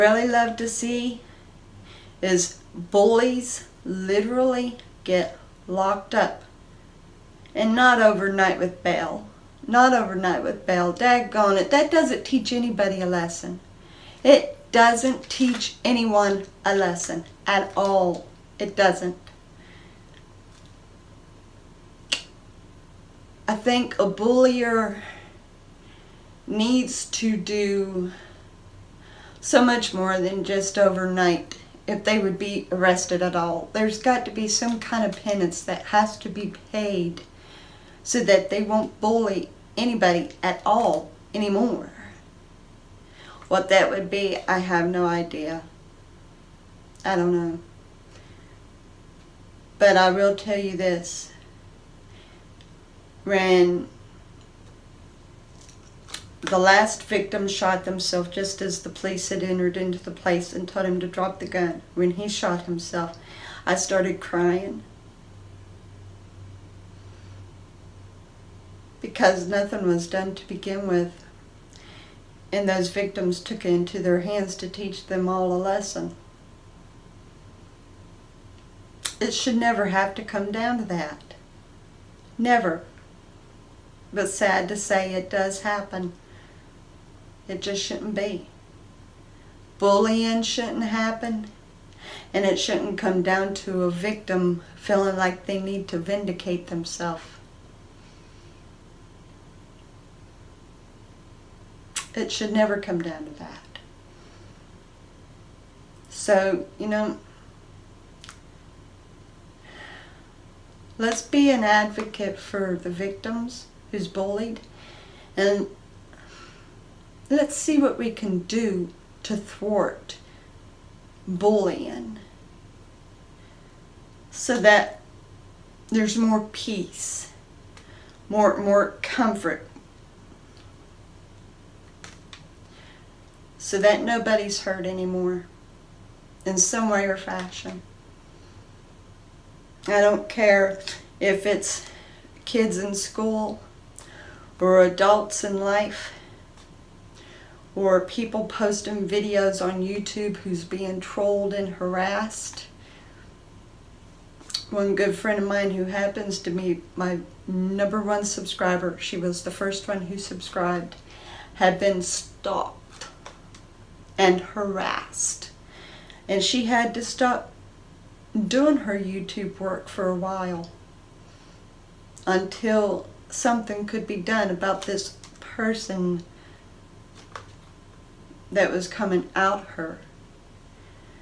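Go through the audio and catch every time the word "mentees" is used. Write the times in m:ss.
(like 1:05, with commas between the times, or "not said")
not said.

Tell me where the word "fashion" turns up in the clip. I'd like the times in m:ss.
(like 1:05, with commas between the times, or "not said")
2:17.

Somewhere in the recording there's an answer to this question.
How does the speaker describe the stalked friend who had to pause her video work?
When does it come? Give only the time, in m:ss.
2:37.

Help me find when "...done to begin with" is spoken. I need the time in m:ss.
1:10.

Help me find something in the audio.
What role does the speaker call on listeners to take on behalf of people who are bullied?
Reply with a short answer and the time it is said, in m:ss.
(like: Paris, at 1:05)
An advocate, at 1:51.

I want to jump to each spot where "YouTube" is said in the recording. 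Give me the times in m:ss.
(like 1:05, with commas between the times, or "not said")
2:29, 2:48.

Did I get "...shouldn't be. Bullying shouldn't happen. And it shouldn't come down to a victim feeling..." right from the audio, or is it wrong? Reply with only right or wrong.
right.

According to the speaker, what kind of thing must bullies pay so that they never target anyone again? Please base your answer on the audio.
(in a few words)
Penance.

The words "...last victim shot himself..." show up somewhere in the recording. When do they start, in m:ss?
0:56.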